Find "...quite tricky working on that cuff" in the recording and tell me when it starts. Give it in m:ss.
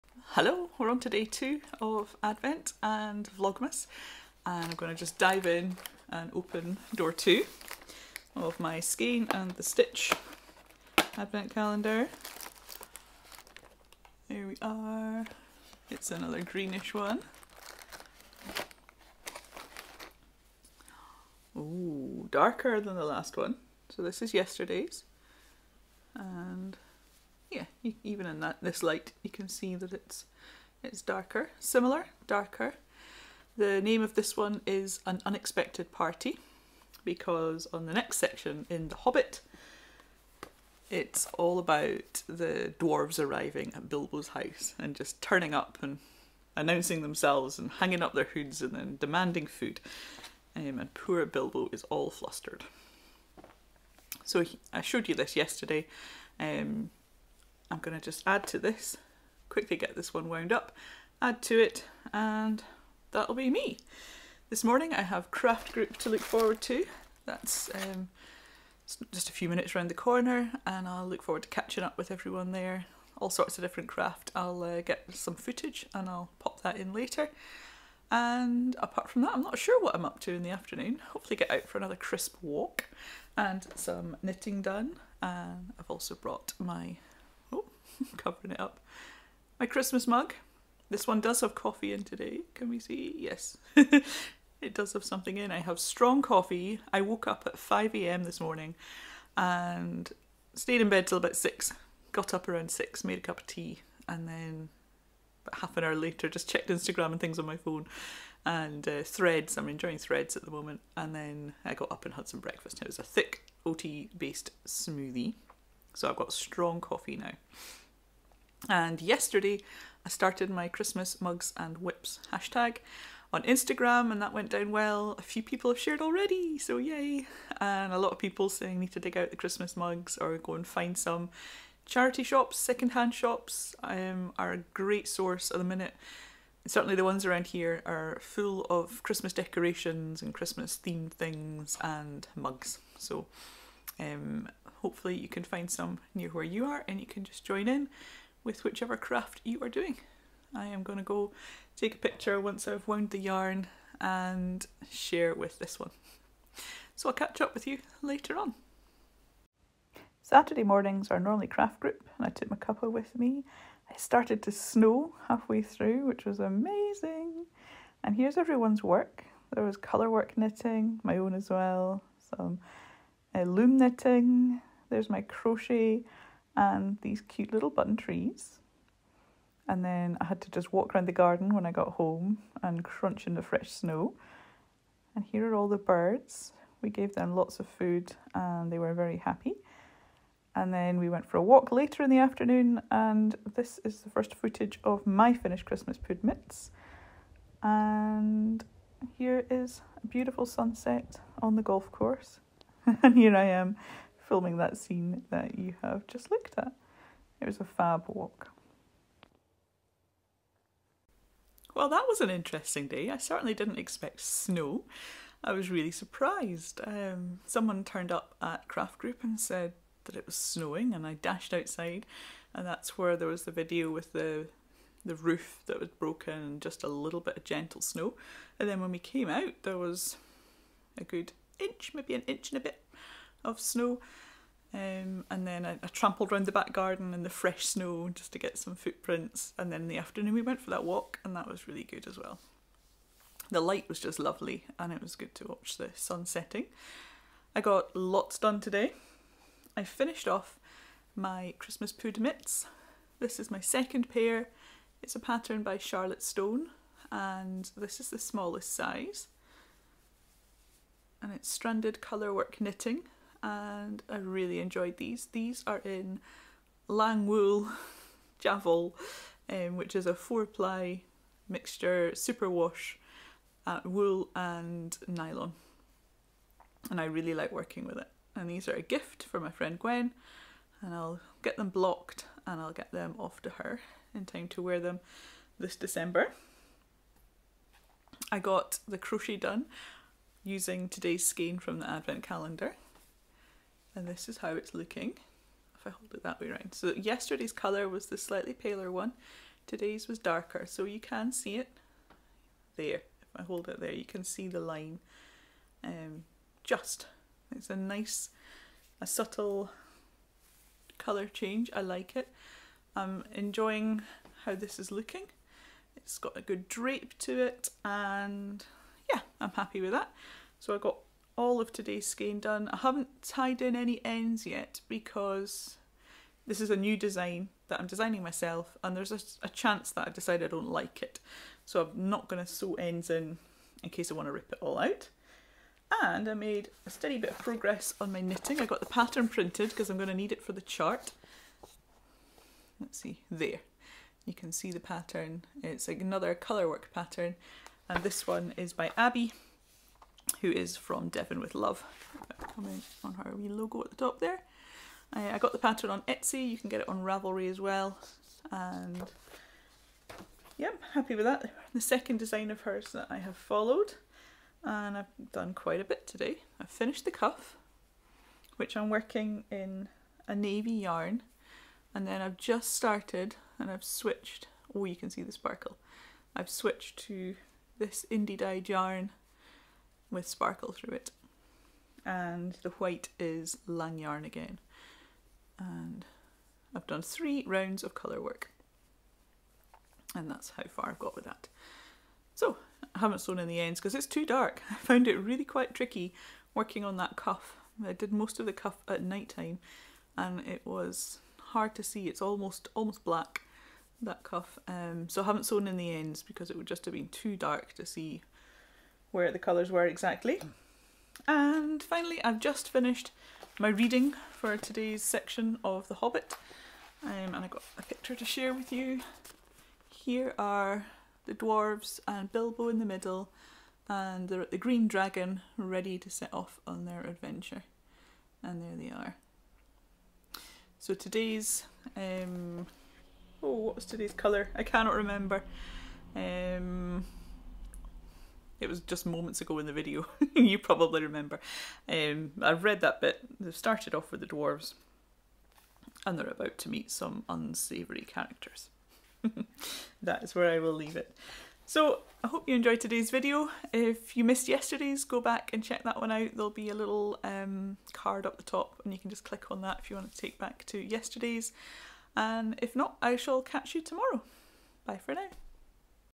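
6:35.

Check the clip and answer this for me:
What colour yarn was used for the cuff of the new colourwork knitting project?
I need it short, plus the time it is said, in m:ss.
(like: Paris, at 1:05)
Navy, at 6:10.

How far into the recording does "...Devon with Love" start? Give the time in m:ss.
5:51.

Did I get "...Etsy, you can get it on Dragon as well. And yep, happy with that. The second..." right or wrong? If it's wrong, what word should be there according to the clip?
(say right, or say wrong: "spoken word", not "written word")
wrong: "Ravelry", not "Dragon".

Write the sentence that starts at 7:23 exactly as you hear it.
They've started off with the dwarves, and they're about to meet some unsavoury characters.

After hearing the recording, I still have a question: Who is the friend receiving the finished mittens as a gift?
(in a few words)
Gwen.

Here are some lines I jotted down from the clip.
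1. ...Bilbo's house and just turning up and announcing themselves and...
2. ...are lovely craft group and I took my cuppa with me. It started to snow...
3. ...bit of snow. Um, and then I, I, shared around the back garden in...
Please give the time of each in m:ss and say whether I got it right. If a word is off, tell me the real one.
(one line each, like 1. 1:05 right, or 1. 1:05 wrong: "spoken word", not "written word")
1. 0:43 right
2. 2:41 wrong: "normally", not "lovely"
3. 3:52 wrong: "trampled", not "shared".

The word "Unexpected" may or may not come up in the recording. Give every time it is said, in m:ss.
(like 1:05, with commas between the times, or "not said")
0:35.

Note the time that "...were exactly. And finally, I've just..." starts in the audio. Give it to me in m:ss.
6:49.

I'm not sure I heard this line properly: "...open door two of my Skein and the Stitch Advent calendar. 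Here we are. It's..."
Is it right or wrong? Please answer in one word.
right.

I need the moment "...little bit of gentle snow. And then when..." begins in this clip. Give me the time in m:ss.
3:46.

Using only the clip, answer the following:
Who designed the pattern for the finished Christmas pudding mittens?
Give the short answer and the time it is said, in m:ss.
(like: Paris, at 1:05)
Charlotte Stone, at 4:15.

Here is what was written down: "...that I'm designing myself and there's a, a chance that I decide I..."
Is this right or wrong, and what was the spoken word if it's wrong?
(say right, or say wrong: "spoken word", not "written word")
right.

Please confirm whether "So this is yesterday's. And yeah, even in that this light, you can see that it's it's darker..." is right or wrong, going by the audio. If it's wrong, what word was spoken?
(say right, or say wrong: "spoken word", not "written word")
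right.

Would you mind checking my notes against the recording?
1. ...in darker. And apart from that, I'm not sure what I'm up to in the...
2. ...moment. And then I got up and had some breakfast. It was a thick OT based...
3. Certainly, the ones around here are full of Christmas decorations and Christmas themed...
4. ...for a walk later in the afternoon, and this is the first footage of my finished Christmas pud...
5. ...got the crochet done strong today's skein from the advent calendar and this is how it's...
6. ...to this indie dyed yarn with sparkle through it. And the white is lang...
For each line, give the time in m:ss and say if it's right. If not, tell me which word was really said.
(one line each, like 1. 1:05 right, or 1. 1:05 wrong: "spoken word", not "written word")
1. 1:16 wrong: "later", not "darker"
2. 1:50 right
3. 2:16 right
4. 3:11 right
5. 4:48 wrong: "using", not "strong"
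6. 6:17 right.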